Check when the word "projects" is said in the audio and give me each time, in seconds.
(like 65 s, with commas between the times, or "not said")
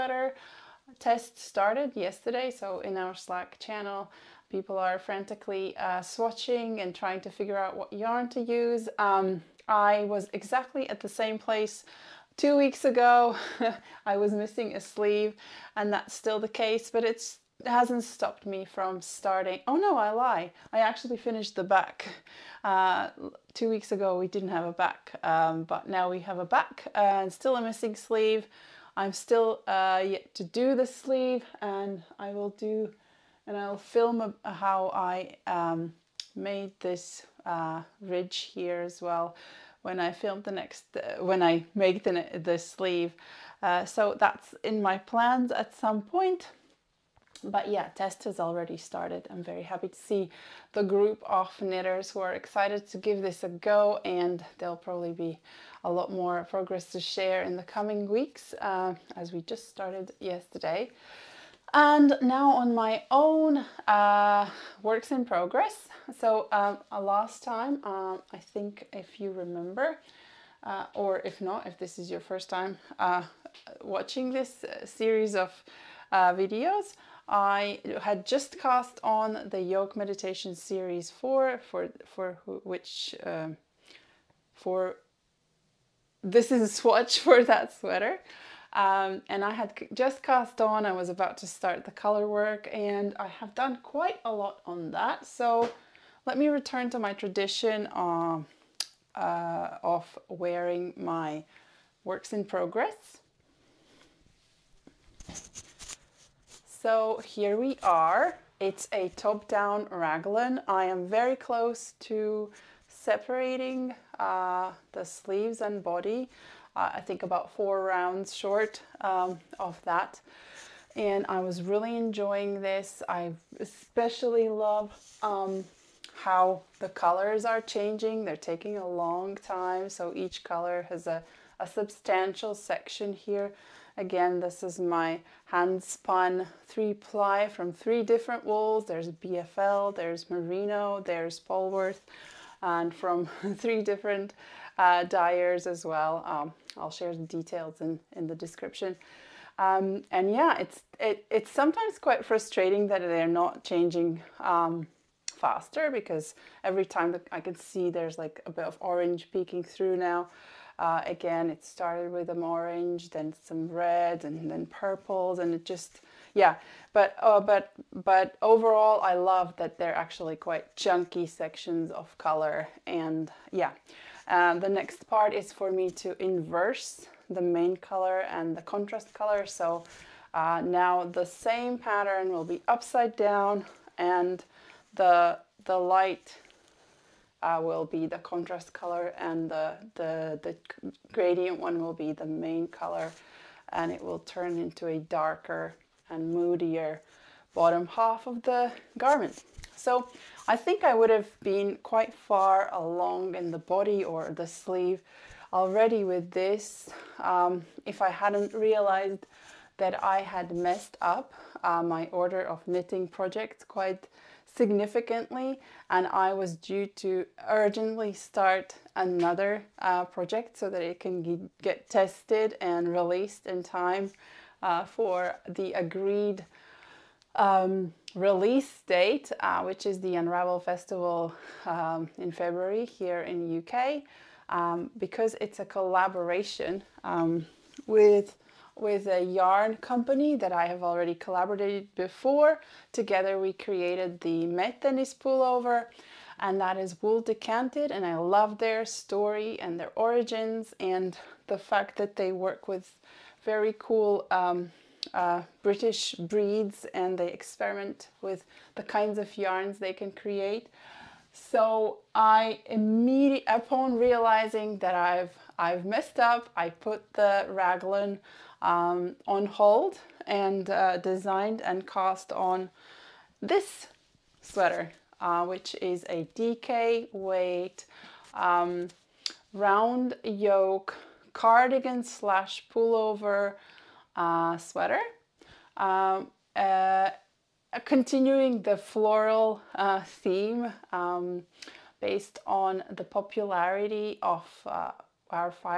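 213 s, 220 s.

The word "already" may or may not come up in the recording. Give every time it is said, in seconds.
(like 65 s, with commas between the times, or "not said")
48 s, 205 s, 240 s.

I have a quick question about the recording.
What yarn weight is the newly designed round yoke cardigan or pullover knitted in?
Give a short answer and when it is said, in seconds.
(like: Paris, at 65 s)
DK, at 276 s.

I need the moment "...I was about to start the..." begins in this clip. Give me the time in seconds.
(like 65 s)
90 s.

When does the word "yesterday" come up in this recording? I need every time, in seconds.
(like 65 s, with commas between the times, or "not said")
1 s, 60 s.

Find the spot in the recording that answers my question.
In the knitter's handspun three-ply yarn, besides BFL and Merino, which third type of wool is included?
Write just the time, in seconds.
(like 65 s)
141 s.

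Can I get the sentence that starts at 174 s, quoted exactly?
Uh, the next part is for me to inverse the main color and the contrast color.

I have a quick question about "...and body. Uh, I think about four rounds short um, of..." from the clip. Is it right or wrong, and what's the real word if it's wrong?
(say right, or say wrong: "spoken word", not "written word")
right.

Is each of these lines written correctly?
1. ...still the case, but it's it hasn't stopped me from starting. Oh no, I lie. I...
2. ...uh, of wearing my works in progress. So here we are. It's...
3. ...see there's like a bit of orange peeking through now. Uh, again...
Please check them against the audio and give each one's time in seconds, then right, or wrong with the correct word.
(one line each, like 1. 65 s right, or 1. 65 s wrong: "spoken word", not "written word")
1. 16 s right
2. 99 s right
3. 157 s right.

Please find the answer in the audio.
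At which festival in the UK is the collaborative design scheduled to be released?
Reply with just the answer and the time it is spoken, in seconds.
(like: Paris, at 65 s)
Unravel Festival, at 230 s.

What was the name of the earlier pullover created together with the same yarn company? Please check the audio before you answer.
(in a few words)
Mettenis pullover.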